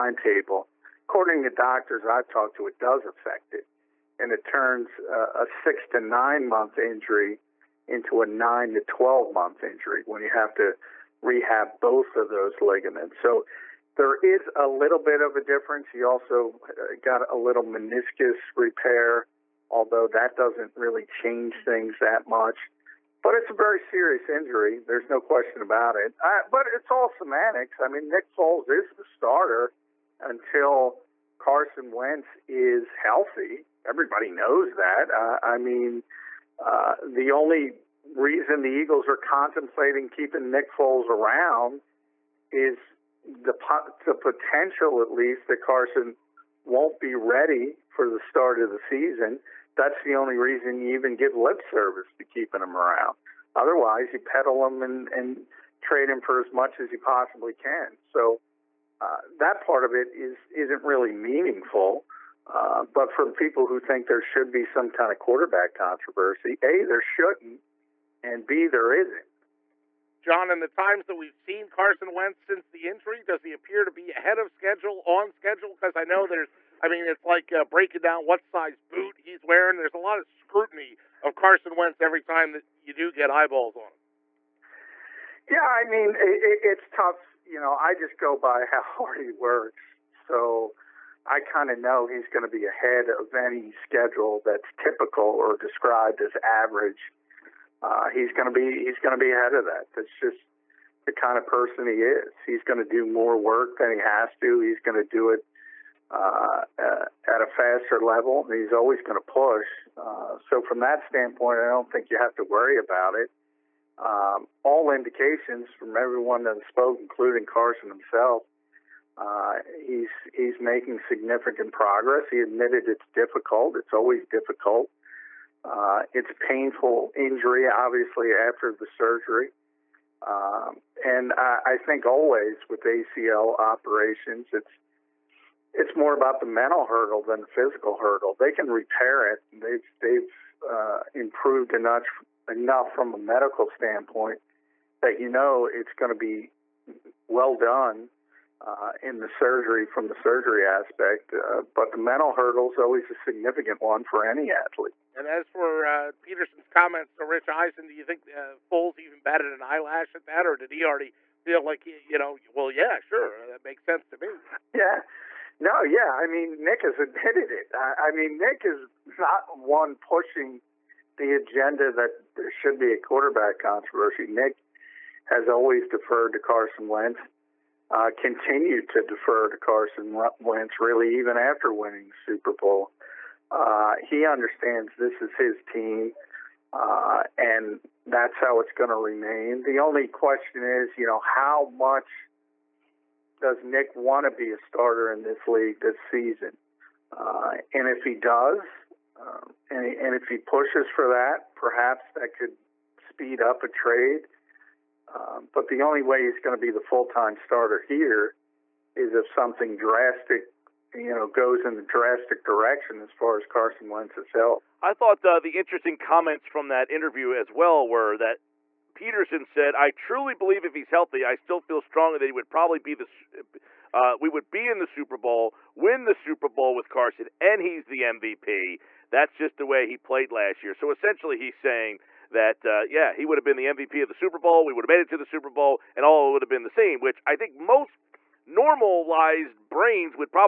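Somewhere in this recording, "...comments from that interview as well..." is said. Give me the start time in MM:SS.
03:35.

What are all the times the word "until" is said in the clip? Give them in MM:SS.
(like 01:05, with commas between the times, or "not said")
00:30.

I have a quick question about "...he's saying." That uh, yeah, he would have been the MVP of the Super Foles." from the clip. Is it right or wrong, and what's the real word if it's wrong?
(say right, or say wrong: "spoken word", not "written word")
wrong: "Bowl", not "Foles".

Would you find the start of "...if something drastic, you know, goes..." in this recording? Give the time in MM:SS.
03:29.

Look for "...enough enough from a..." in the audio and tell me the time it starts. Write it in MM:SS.
02:21.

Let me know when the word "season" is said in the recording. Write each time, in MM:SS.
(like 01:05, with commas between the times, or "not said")
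00:48, 03:16.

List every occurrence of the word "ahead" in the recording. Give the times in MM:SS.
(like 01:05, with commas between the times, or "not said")
01:14, 01:32, 01:39.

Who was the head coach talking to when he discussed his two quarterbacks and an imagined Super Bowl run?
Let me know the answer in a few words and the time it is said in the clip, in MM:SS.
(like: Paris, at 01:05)
Rich Eisen, at 02:37.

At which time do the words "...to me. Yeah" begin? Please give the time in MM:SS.
02:44.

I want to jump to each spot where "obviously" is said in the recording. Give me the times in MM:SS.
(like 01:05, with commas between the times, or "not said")
02:07.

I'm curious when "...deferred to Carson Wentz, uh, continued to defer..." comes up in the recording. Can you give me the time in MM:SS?
02:55.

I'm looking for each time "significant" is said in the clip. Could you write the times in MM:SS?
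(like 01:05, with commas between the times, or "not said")
02:01, 02:33.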